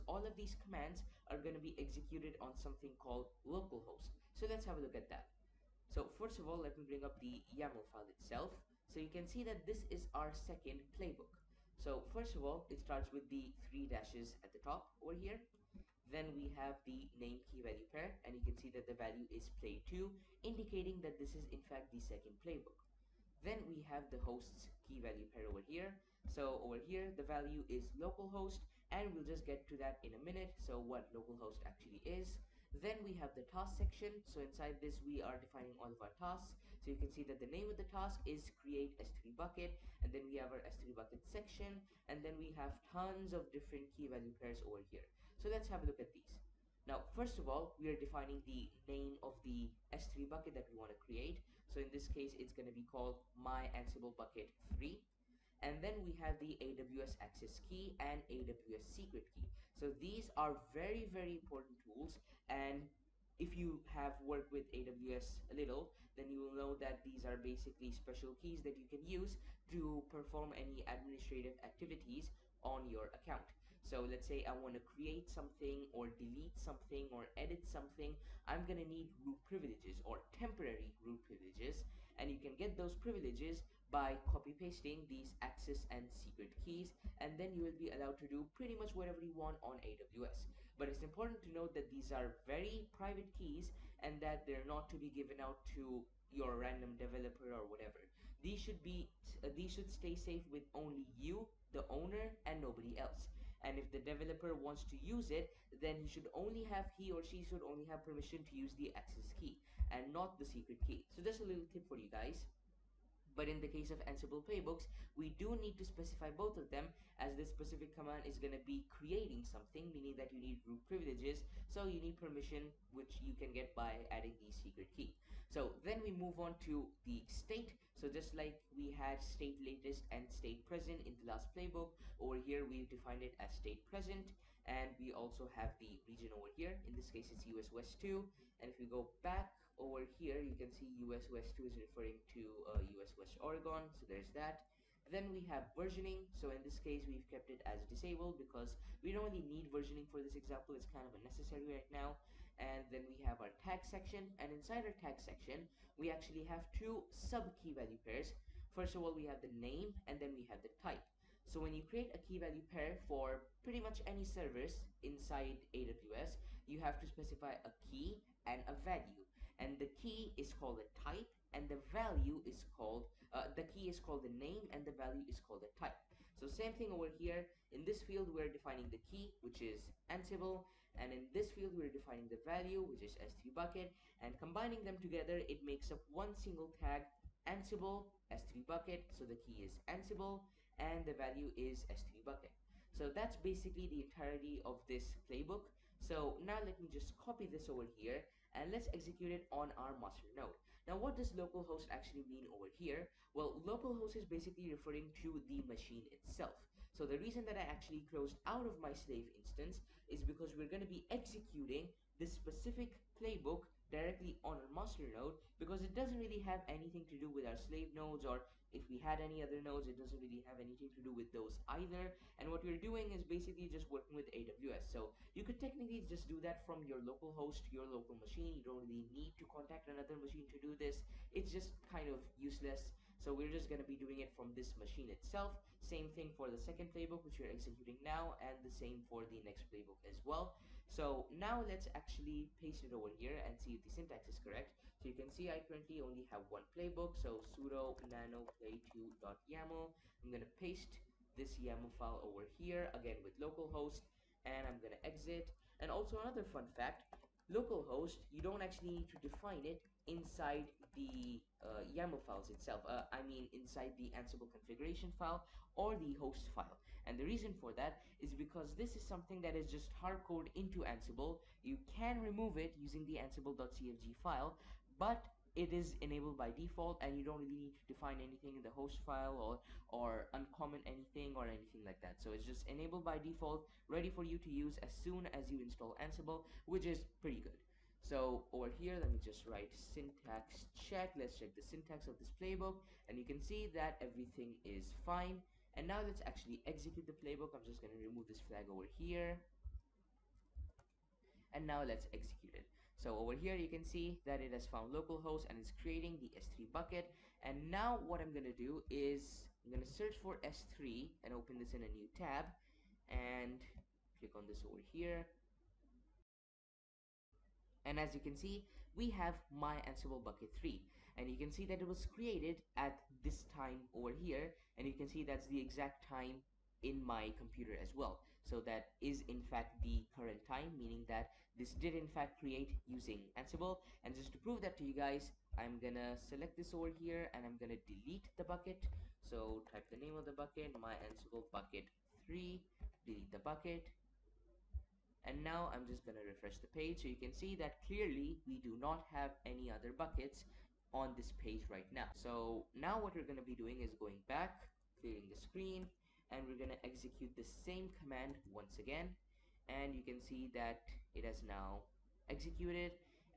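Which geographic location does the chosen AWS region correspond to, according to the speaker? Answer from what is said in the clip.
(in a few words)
Oregon.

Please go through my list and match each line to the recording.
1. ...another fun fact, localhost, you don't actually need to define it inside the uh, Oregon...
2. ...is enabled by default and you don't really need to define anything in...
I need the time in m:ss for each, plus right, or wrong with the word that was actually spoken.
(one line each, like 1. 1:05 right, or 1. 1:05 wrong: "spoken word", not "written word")
1. 4:16 wrong: "YAML", not "Oregon"
2. 4:35 right.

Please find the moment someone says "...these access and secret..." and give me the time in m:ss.
1:25.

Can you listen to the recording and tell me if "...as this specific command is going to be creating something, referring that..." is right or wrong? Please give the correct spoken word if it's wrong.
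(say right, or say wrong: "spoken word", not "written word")
wrong: "meaning", not "referring".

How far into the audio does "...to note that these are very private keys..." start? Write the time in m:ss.
1:31.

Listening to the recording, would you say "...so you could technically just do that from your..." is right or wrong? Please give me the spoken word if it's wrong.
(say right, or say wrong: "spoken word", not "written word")
right.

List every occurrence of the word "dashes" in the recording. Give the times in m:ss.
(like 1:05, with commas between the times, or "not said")
0:13.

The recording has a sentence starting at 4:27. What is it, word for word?
And the reason for that is because this is something that is just hardcoded into Ansible.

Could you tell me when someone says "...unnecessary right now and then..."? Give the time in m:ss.
2:31.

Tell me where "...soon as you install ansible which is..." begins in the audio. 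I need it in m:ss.
4:45.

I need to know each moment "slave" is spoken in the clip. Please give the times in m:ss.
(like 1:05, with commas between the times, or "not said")
3:28, 3:37.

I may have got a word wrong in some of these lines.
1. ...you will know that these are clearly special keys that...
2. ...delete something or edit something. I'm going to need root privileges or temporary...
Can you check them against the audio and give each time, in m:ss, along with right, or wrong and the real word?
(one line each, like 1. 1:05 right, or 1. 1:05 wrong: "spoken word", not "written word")
1. 1:06 wrong: "basically", not "clearly"
2. 1:16 right.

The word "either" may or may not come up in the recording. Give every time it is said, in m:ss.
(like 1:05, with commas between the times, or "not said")
3:41.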